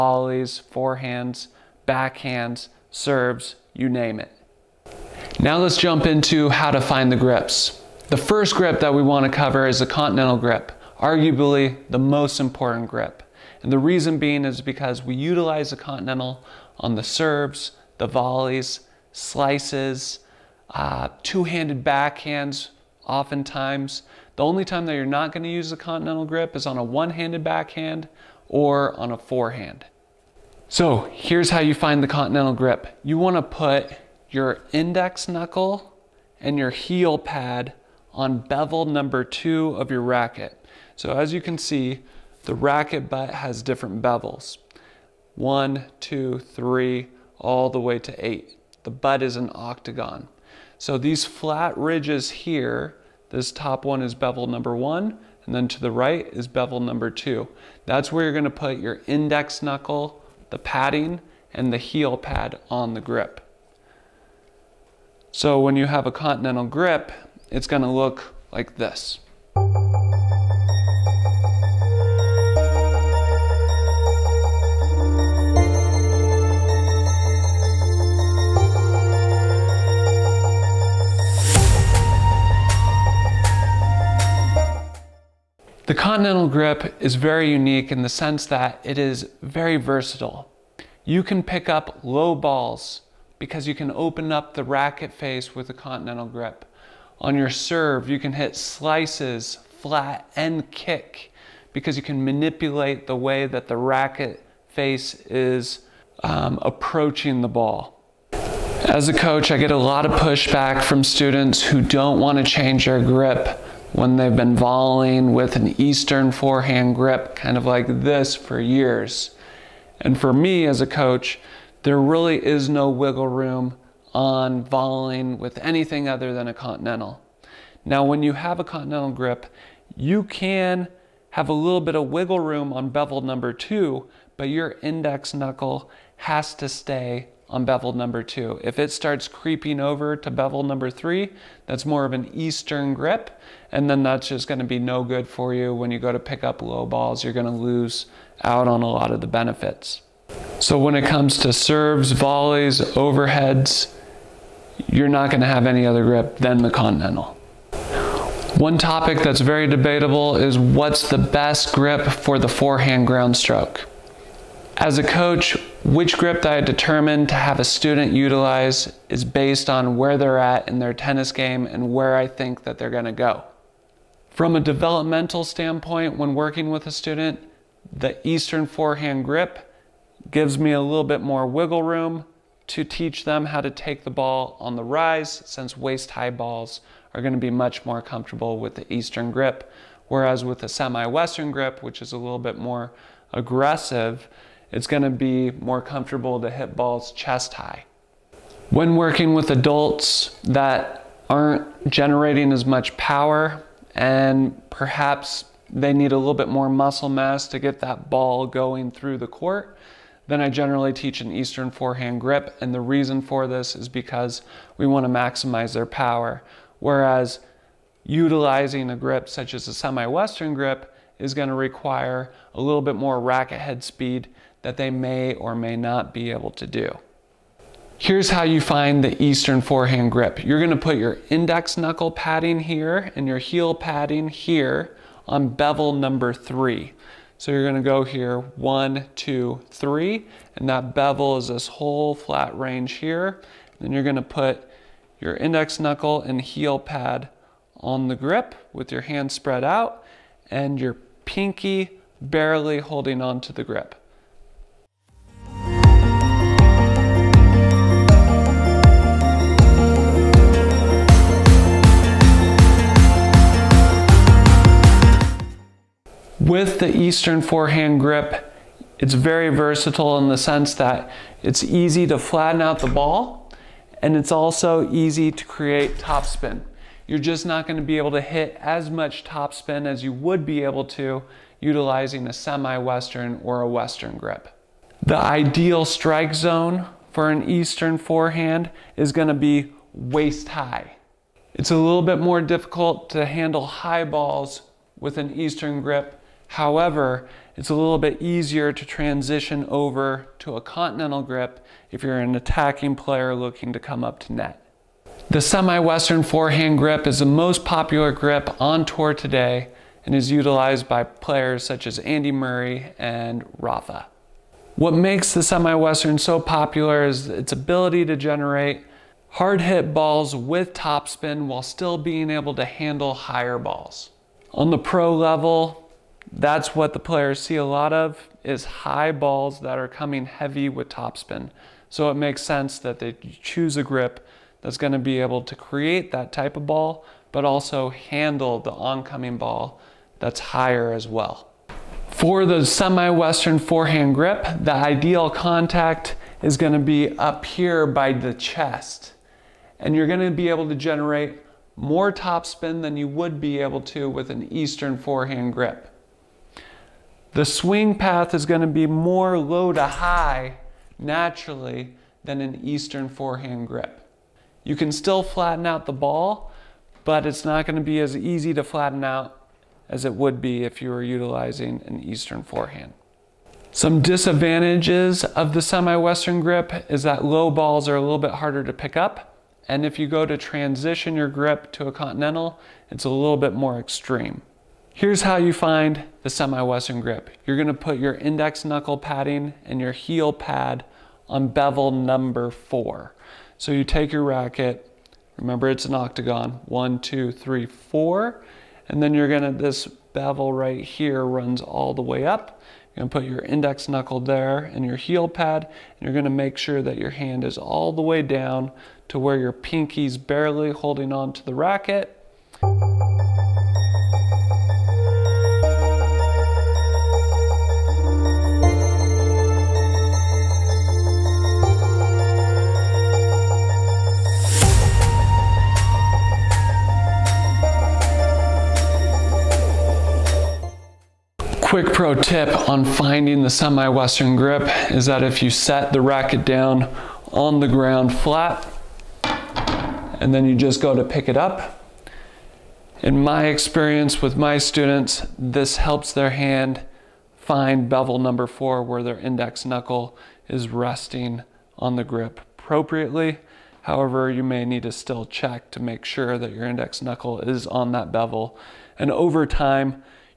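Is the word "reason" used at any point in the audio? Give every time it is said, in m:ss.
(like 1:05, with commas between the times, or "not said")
0:13, 3:32.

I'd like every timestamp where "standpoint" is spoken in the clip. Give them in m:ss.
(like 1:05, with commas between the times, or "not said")
2:55.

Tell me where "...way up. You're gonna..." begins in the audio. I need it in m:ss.
6:42.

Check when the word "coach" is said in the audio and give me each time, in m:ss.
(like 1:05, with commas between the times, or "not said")
1:49, 2:00, 2:45.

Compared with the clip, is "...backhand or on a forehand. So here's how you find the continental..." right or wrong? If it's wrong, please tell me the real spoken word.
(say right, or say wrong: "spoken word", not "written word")
right.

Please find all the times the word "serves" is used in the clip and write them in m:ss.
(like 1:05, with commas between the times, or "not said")
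0:02, 0:17, 1:37, 2:31.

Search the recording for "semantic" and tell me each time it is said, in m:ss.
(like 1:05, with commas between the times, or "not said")
not said.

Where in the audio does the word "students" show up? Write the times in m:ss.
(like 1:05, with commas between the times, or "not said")
1:51, 2:47, 2:56, 7:24.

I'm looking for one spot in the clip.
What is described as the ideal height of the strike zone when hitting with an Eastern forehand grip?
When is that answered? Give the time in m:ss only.
4:49.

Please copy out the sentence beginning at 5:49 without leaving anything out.
And you're going to be able to generate more topspin than you would be able to with an eastern forehand grip.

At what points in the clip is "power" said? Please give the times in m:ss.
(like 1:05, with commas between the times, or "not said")
3:22, 3:35.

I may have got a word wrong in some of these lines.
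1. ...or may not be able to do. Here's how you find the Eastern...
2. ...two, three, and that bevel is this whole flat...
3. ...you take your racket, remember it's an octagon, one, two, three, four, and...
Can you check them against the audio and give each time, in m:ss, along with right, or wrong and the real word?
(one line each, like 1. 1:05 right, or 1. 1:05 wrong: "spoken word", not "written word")
1. 3:45 right
2. 3:59 right
3. 6:33 right.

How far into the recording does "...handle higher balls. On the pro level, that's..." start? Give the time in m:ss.
5:22.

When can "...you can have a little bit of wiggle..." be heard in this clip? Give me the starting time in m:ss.
2:09.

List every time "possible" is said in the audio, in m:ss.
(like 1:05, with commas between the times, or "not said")
not said.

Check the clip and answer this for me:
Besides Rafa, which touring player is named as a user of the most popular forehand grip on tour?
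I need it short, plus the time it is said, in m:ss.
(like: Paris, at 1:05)
Andy Murray, at 5:12.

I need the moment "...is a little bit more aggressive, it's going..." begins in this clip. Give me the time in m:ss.
3:12.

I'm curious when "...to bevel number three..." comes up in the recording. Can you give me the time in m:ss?
2:20.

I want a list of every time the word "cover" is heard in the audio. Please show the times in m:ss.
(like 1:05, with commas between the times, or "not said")
0:09.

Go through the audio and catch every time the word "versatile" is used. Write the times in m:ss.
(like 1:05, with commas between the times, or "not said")
1:29, 4:29.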